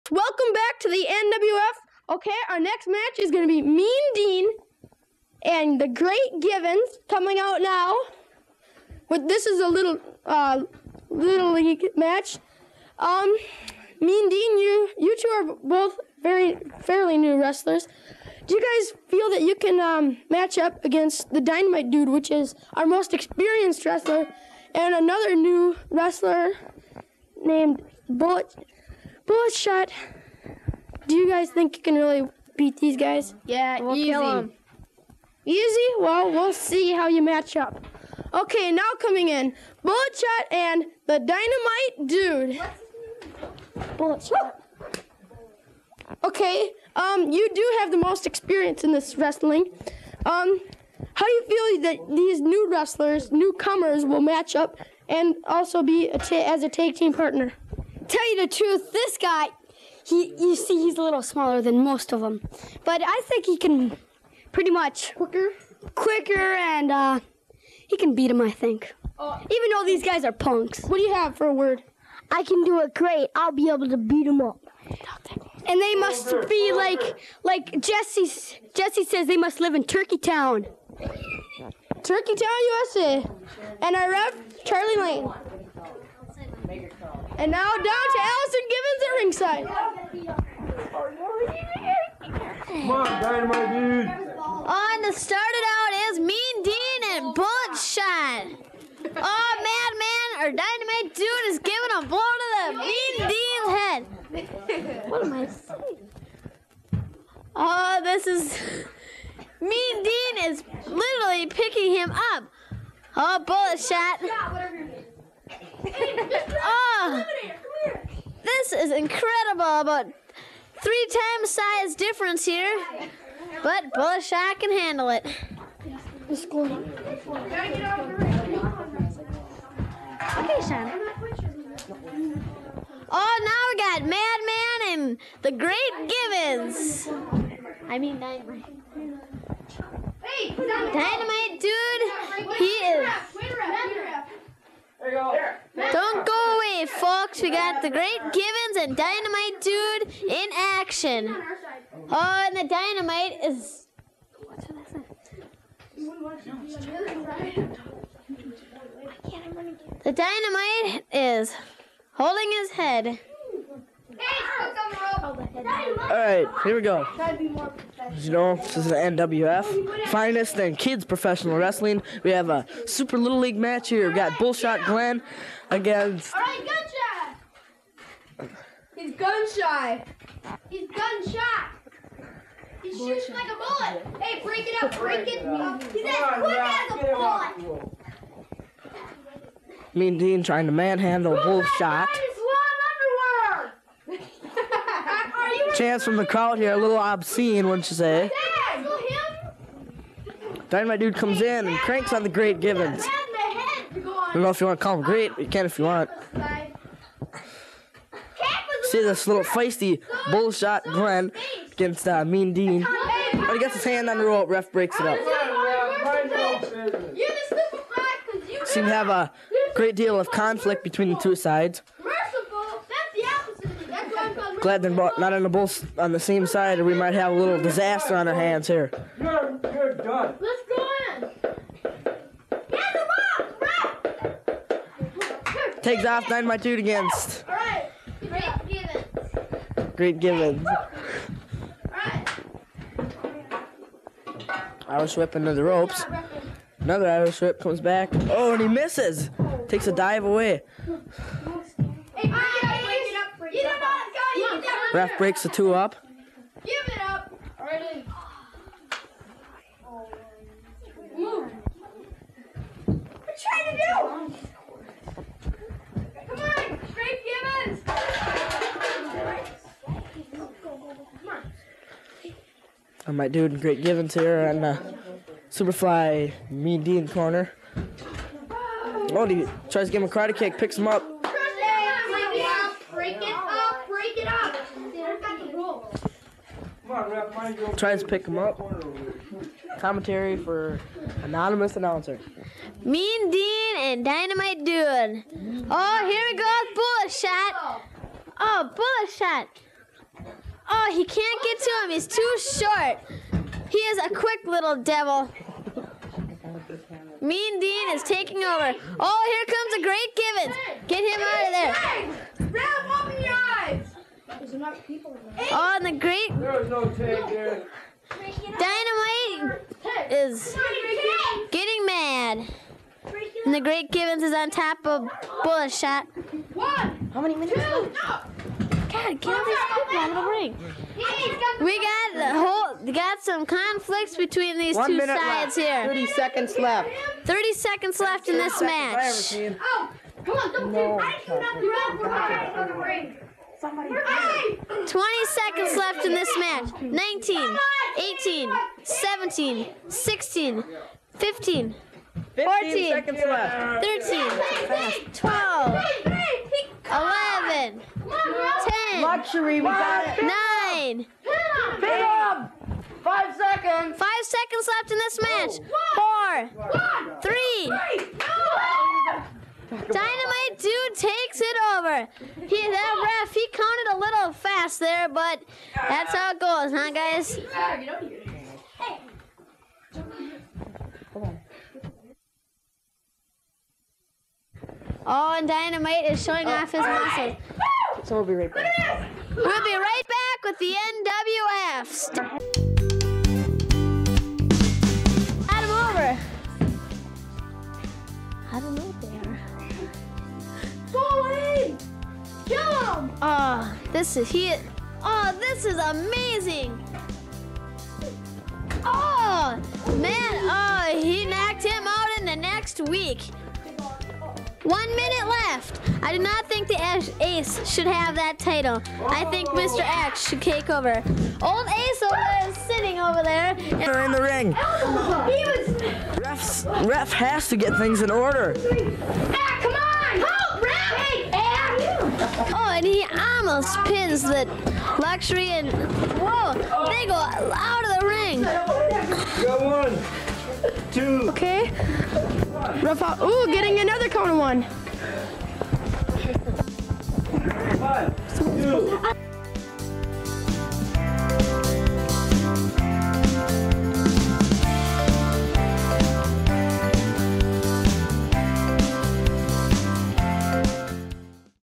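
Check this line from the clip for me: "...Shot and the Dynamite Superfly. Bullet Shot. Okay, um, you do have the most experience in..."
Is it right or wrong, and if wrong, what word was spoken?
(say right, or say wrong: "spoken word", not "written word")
wrong: "Dude", not "Superfly".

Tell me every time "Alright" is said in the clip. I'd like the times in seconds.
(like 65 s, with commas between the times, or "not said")
166 s.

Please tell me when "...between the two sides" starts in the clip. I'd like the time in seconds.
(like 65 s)
220 s.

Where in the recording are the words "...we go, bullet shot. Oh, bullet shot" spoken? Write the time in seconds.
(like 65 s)
296 s.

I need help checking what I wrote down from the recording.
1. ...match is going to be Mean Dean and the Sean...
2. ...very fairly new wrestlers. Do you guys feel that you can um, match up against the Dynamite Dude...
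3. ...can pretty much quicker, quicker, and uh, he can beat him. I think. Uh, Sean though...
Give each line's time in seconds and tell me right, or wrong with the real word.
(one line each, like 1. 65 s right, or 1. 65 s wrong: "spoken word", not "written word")
1. 2 s wrong: "Great", not "Sean"
2. 16 s right
3. 63 s wrong: "Even", not "Sean".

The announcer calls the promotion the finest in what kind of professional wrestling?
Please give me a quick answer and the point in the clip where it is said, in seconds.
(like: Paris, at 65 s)
Kids, at 170 s.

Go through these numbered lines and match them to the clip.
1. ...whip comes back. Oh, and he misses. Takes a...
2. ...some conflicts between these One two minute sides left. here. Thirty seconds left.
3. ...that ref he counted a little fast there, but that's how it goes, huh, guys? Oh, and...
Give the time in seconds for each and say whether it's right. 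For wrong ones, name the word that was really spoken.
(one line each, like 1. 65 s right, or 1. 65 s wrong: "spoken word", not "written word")
1. 247 s right
2. 333 s right
3. 372 s right.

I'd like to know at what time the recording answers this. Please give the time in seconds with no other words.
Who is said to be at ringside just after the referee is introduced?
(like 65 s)
88 s.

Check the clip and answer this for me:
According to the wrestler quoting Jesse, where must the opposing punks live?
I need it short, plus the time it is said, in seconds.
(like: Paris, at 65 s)
Turkey Town, at 82 s.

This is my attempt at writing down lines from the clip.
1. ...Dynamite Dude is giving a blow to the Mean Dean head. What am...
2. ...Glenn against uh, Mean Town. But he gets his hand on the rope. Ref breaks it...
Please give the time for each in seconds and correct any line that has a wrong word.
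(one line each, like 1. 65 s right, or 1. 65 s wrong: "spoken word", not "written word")
1. 100 s right
2. 210 s wrong: "Dean", not "Town".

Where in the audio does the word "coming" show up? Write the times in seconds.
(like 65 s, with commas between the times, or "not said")
7 s, 38 s.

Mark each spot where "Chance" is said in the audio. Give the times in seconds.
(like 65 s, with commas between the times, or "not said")
195 s.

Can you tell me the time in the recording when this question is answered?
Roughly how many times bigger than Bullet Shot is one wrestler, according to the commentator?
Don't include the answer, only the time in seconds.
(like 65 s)
119 s.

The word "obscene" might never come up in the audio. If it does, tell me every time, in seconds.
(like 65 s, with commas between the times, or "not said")
196 s.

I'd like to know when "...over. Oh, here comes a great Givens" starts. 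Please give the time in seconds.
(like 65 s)
308 s.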